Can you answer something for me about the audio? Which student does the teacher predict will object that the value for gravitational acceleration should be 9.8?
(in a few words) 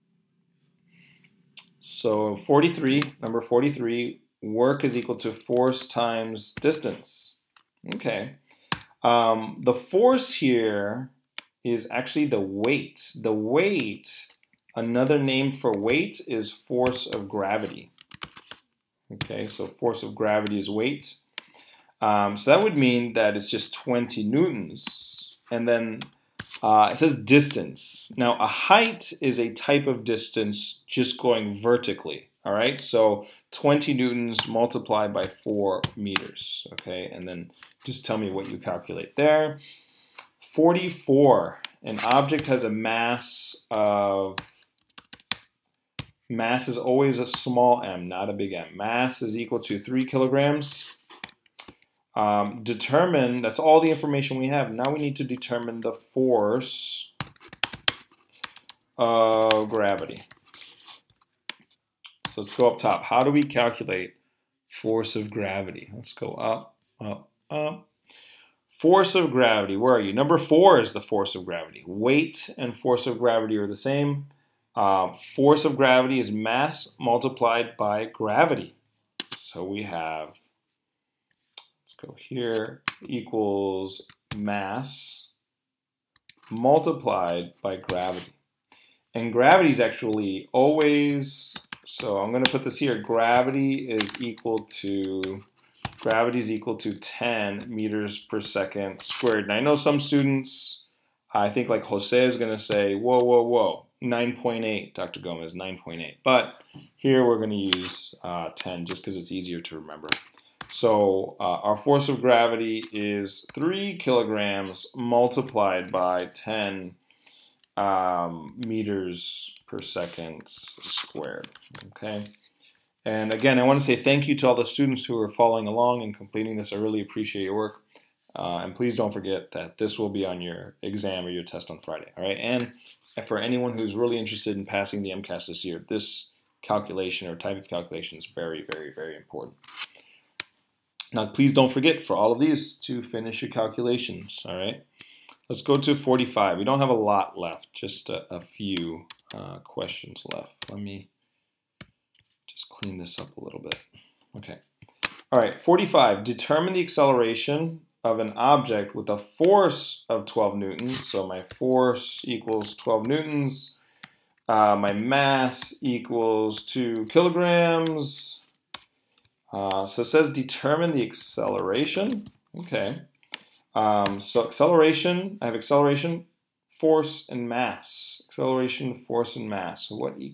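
Jose.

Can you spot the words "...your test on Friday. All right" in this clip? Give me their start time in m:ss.
2:11.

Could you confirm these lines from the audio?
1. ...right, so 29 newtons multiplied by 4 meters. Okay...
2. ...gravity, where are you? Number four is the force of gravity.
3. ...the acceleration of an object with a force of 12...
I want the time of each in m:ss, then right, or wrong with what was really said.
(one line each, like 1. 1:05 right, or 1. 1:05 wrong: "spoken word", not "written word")
1. 0:32 wrong: "20", not "29"
2. 1:09 right
3. 2:36 right.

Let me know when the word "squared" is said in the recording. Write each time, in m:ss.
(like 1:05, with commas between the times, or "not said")
1:39, 2:00.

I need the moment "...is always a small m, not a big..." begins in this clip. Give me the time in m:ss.
0:46.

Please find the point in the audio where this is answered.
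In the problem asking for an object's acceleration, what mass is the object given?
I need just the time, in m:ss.
2:46.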